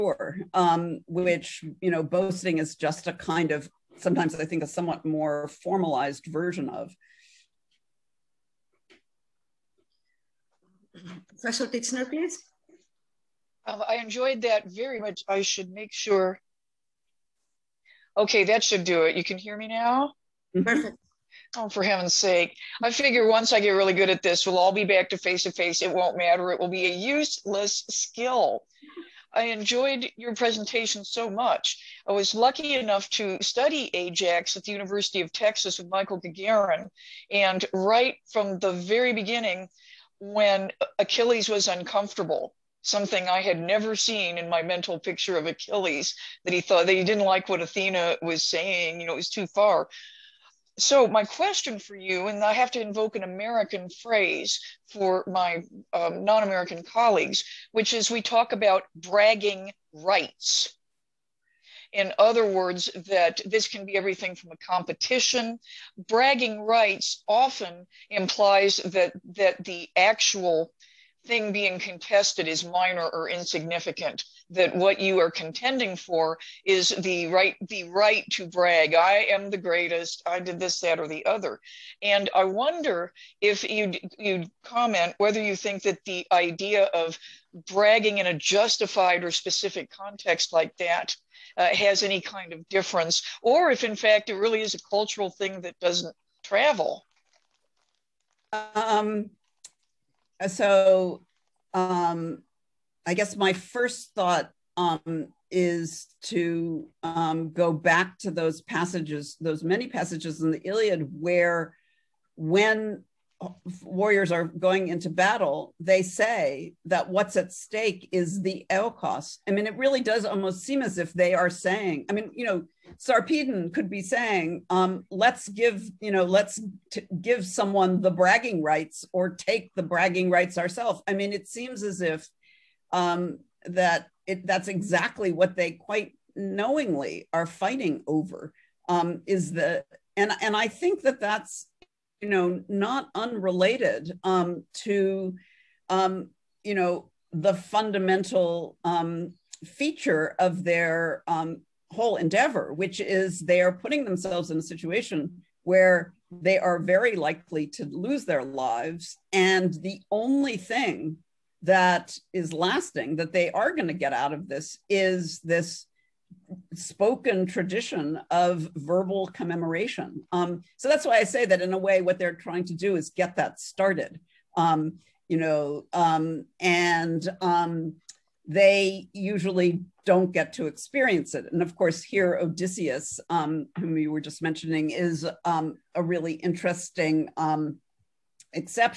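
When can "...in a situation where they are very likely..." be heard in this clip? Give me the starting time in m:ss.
2:34.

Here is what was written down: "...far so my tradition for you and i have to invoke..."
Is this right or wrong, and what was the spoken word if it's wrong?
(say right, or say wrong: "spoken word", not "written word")
wrong: "question", not "tradition".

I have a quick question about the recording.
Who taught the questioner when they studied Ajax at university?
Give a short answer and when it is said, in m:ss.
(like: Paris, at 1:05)
Michael Gagarin, at 0:35.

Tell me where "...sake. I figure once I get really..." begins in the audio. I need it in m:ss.
0:22.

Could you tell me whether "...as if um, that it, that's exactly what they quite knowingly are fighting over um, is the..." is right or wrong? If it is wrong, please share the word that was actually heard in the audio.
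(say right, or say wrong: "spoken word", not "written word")
right.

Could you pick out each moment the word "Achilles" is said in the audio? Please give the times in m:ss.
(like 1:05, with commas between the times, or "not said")
0:40, 0:45.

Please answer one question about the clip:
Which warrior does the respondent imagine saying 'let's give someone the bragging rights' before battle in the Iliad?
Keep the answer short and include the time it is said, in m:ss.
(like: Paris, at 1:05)
Sarpedon, at 2:02.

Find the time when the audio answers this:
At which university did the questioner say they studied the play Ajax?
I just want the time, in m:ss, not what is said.
0:34.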